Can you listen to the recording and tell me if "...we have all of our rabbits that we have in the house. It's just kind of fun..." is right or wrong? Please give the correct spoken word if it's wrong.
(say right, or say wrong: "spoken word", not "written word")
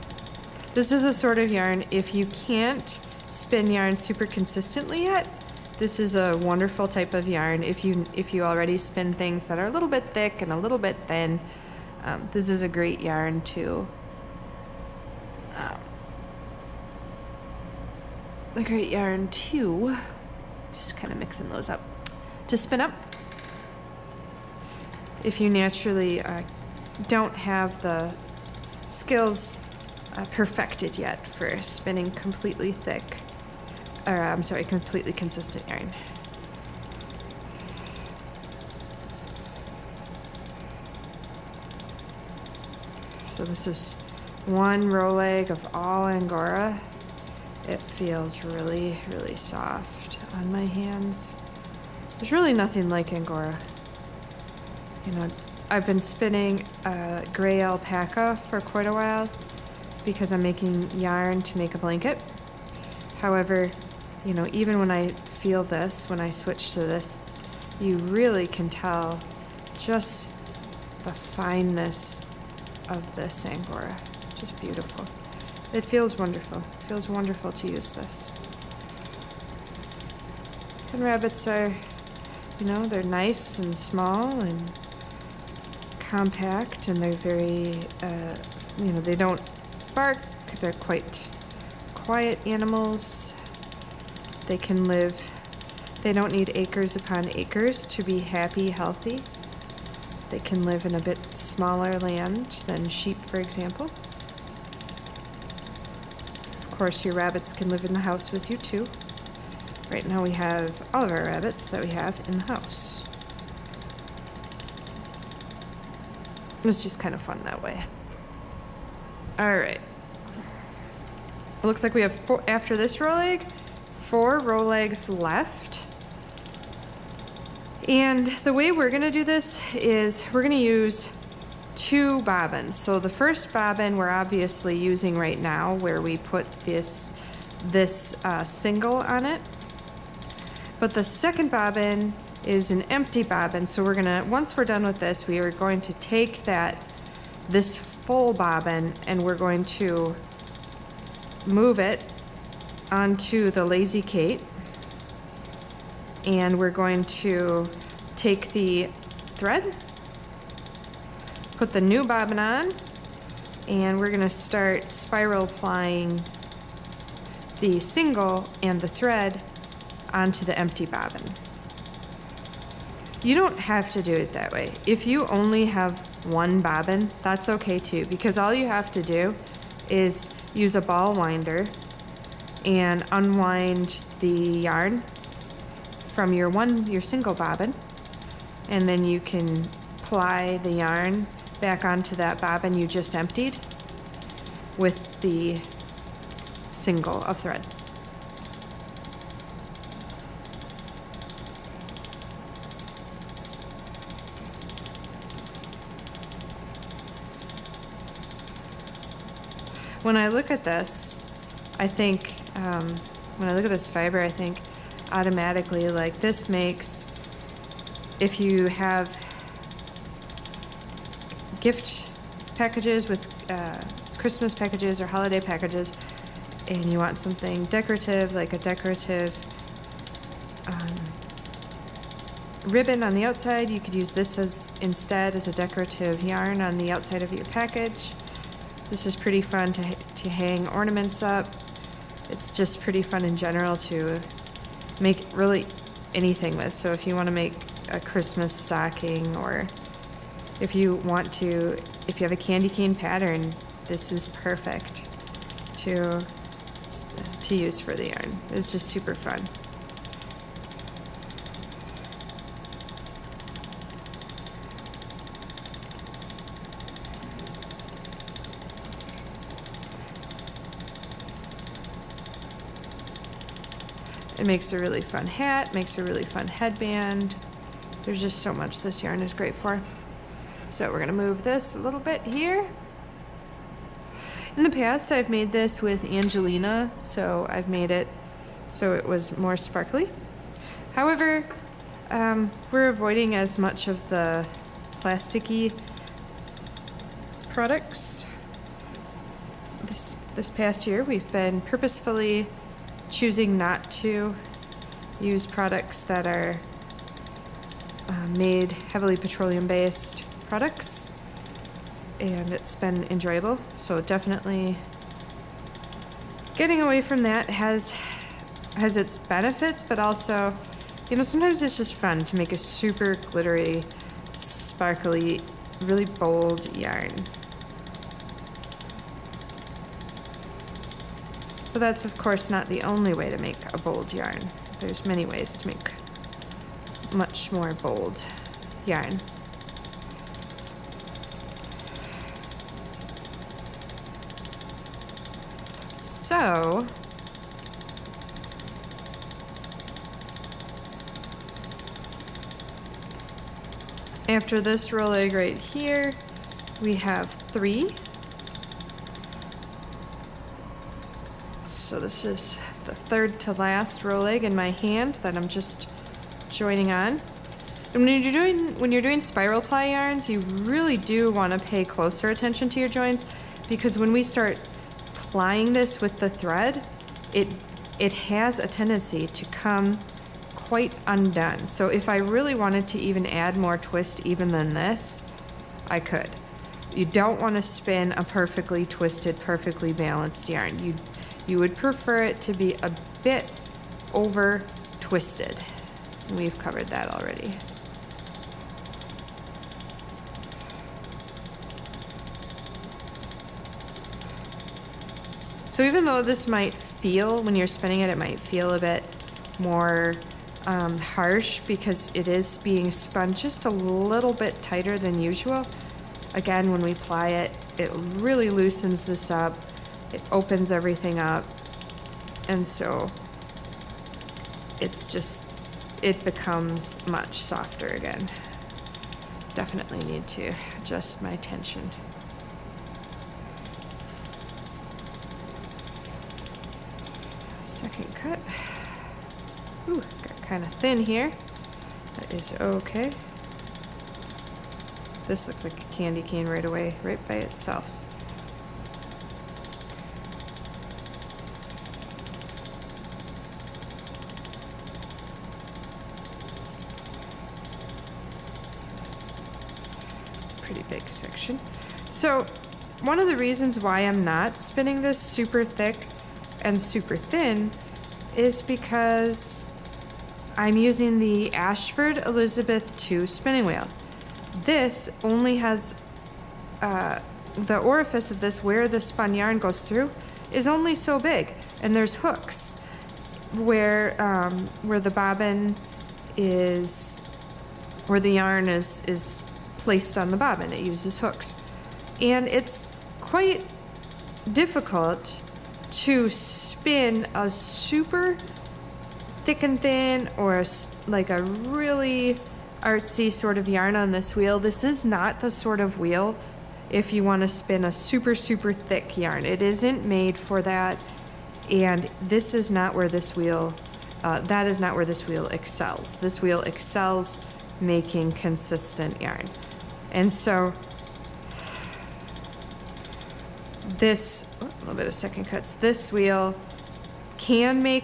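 right.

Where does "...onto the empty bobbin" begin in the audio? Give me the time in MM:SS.
02:50.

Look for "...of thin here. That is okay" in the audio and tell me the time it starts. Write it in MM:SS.
07:20.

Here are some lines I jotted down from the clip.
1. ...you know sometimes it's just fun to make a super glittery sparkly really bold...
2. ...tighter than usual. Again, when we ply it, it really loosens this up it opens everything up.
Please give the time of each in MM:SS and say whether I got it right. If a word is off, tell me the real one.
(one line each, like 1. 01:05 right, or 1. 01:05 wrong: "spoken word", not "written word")
1. 05:21 right
2. 06:54 right.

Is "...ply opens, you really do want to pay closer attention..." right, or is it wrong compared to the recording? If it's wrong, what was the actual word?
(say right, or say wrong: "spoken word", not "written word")
wrong: "yarns", not "opens".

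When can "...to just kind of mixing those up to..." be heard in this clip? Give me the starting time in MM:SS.
00:19.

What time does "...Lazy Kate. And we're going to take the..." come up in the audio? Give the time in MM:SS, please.
02:33.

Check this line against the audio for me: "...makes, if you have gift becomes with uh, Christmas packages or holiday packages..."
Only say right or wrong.
wrong.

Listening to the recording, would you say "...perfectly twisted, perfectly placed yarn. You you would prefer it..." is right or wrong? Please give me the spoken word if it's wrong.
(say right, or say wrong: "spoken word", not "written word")
wrong: "balanced", not "placed".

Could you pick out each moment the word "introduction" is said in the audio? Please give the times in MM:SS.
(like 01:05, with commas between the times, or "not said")
not said.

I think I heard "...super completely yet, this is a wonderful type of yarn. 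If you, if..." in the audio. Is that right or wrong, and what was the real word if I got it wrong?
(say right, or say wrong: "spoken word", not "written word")
wrong: "consistently", not "completely".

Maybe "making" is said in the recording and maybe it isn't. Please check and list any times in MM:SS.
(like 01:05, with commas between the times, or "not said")
01:00, 08:37.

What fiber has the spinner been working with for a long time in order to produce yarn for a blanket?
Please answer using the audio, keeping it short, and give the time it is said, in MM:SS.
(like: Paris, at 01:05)
gray alpaca, at 00:57.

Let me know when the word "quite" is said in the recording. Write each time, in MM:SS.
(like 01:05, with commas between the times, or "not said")
00:58, 01:30, 06:20, 08:13.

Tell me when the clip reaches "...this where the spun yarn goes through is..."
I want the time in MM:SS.
07:58.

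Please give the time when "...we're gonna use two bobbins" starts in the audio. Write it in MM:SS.
02:10.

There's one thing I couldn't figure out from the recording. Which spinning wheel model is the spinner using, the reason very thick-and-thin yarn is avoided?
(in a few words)
Ashford Elizabeth II.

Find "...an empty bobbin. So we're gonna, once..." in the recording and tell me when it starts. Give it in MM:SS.
02:22.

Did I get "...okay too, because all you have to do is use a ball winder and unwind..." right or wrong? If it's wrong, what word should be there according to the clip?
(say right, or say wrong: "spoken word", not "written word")
right.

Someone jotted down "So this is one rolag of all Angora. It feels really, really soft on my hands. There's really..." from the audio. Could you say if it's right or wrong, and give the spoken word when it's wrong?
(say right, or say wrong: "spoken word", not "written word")
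right.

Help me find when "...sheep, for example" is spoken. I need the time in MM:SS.
01:42.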